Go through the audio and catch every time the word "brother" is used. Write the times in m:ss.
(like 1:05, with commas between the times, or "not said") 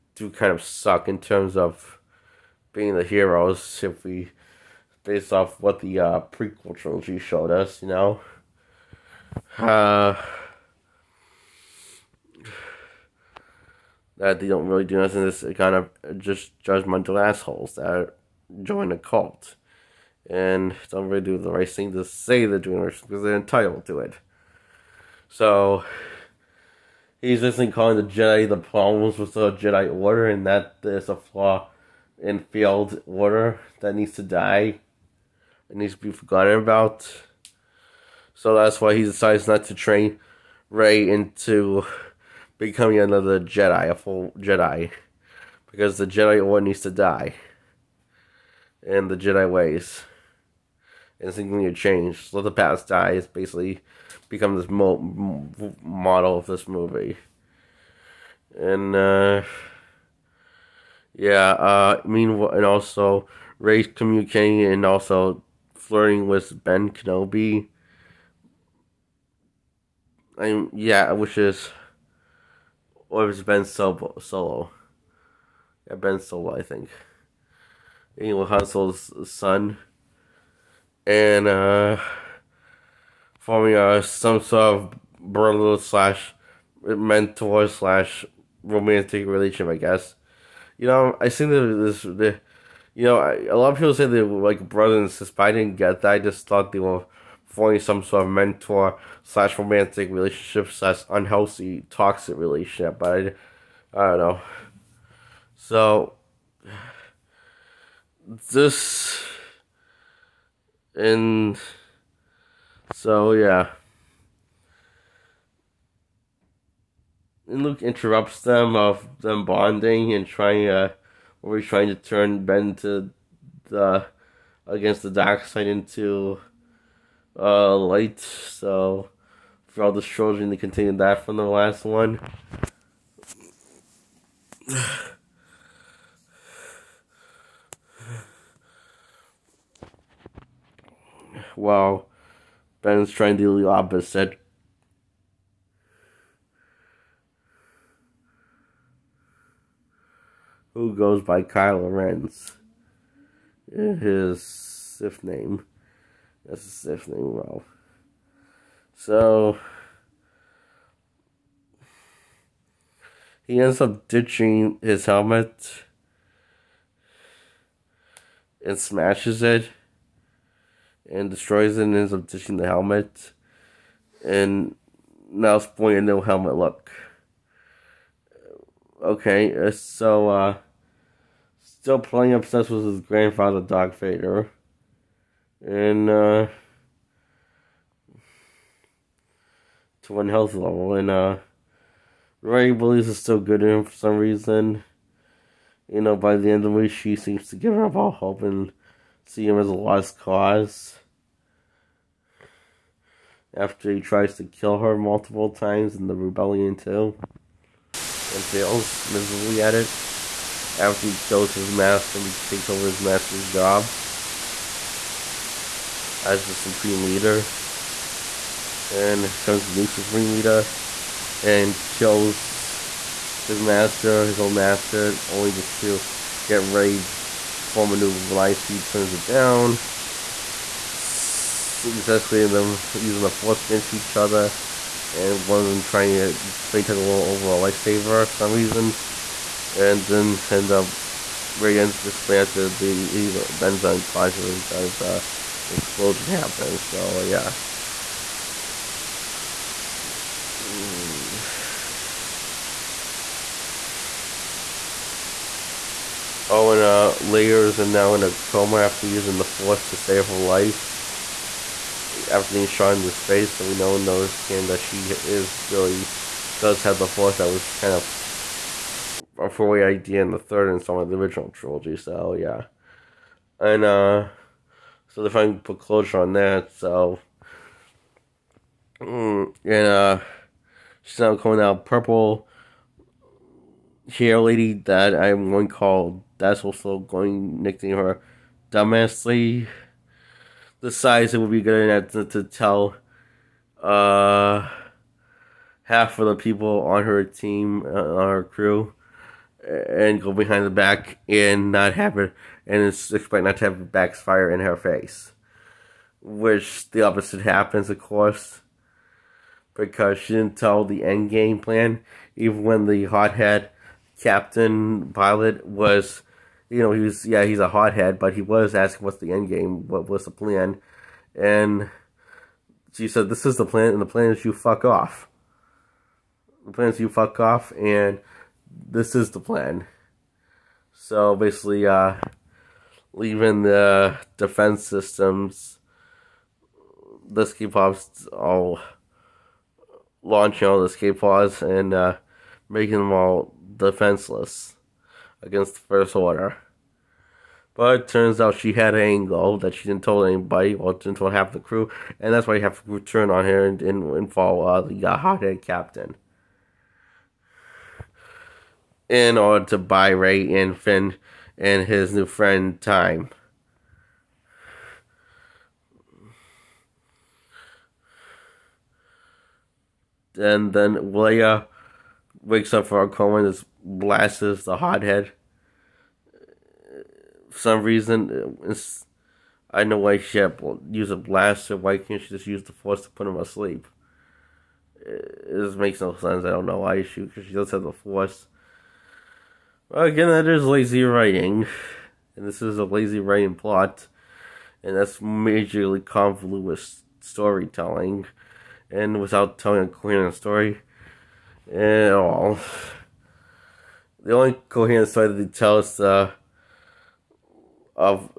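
1:25, 1:34.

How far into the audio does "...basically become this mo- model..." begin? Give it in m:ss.
0:53.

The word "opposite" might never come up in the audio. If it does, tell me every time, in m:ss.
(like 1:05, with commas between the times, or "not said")
2:23, 5:07.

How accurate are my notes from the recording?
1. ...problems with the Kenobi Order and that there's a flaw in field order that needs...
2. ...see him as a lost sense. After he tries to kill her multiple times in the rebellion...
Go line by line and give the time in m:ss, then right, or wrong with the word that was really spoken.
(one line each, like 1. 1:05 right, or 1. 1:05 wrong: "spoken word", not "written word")
1. 0:28 wrong: "Jedi", not "Kenobi"
2. 3:19 wrong: "cause", not "sense".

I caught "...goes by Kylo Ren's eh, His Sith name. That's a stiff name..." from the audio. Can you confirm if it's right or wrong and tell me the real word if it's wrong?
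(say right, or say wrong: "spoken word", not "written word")
right.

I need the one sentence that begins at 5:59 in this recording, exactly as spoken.
In order to buy Rey and Finn and his new friend time.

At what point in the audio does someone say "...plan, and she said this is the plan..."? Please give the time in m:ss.
5:20.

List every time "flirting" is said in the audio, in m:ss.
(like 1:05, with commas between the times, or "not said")
1:05.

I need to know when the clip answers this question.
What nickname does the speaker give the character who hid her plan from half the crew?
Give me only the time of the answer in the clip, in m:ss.
4:41.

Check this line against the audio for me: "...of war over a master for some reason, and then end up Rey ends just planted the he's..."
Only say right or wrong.
wrong.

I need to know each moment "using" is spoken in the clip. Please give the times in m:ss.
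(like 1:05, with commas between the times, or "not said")
3:53, 4:19.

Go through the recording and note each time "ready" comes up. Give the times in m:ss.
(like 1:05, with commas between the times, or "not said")
3:46.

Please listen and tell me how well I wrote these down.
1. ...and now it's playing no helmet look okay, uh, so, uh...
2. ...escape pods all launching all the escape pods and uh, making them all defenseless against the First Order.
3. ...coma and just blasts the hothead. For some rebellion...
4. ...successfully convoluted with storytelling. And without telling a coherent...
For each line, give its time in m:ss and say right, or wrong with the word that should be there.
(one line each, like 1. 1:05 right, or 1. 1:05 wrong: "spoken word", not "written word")
1. 2:54 wrong: "pointing", not "playing"
2. 5:37 right
3. 6:13 wrong: "reason", not "rebellion"
4. 6:35 wrong: "majorly", not "successfully".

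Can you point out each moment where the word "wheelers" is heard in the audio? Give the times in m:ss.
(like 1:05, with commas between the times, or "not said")
not said.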